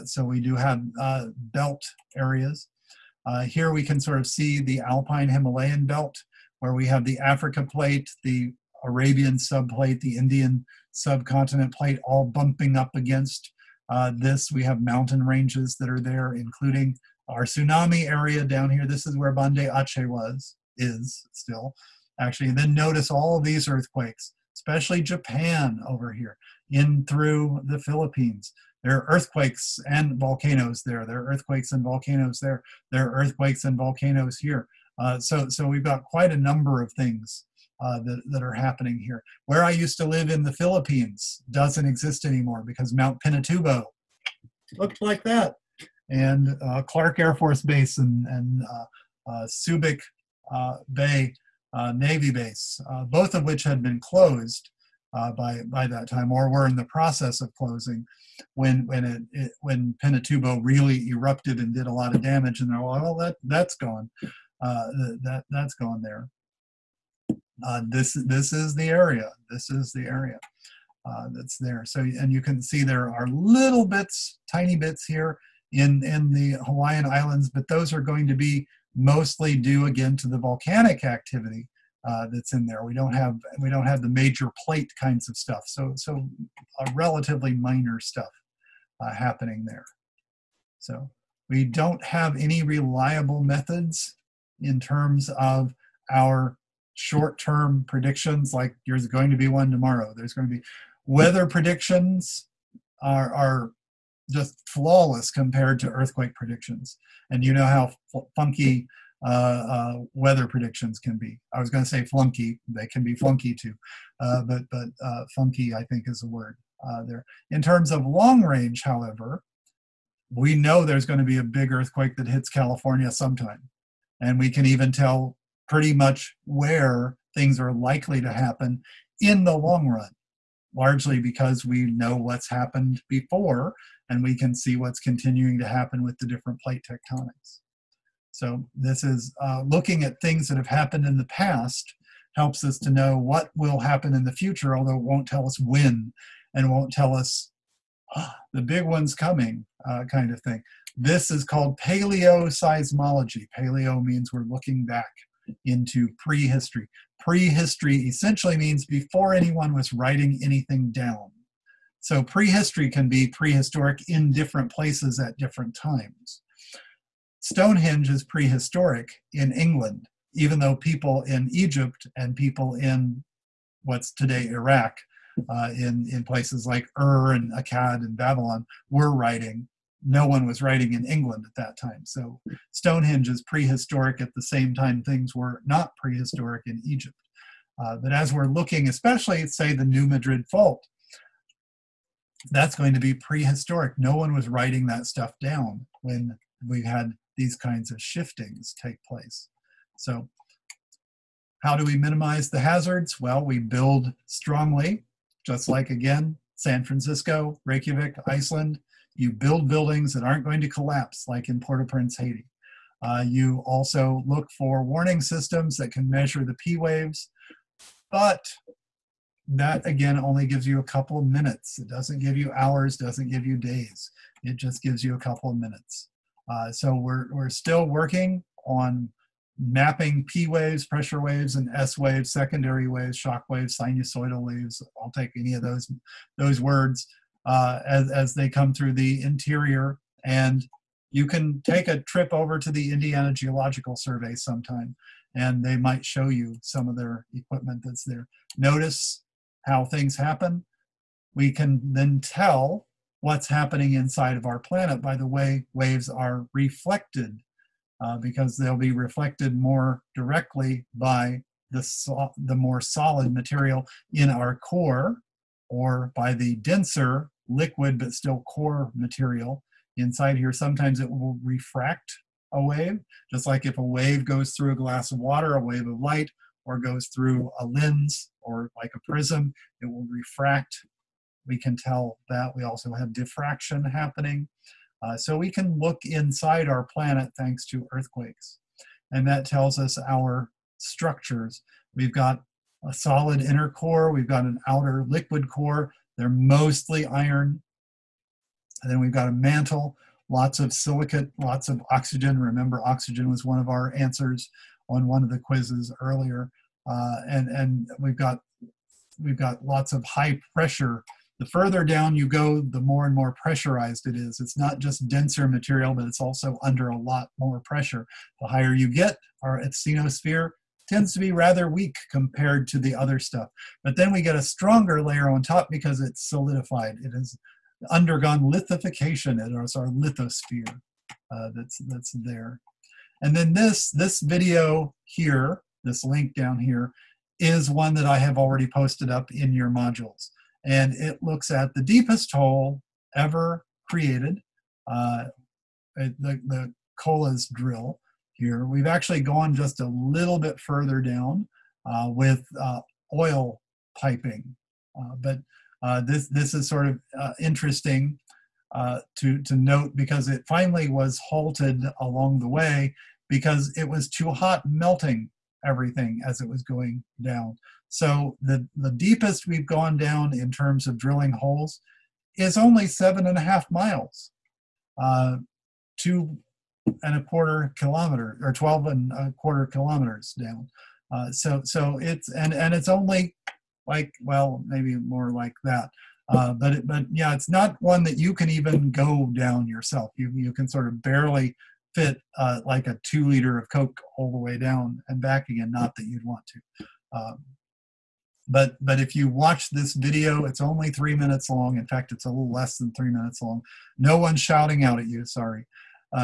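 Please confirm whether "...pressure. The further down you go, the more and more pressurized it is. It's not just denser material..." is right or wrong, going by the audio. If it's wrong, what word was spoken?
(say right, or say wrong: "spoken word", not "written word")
right.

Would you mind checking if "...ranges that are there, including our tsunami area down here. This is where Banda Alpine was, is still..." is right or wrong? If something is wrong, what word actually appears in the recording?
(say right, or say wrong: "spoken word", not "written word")
wrong: "Aceh", not "Alpine".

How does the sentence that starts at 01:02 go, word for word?
And they're like, well, that, that's gone.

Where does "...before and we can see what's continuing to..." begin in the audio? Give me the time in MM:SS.
02:13.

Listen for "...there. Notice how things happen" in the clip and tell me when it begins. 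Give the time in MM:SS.
04:08.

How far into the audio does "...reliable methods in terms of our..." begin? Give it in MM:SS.
01:32.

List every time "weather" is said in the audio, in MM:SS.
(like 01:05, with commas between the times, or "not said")
01:41, 01:50.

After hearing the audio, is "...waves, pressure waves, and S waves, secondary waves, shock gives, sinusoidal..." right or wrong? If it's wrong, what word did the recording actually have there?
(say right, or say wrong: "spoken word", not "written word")
wrong: "waves", not "gives".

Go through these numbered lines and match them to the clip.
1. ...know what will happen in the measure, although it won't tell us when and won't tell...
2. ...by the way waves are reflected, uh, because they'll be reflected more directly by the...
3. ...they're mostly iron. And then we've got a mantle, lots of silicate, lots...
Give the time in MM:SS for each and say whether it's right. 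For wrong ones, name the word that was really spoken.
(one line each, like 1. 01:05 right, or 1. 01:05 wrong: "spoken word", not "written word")
1. 02:22 wrong: "future", not "measure"
2. 04:15 right
3. 04:56 right.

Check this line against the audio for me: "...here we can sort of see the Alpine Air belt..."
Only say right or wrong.
wrong.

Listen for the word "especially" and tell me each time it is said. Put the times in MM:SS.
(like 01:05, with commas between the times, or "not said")
00:24, 03:08.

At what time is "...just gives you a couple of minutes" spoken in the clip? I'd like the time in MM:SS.
03:44.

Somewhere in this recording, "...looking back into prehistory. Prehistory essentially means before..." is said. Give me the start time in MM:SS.
02:34.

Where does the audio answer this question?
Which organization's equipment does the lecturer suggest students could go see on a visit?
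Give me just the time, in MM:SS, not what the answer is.
04:02.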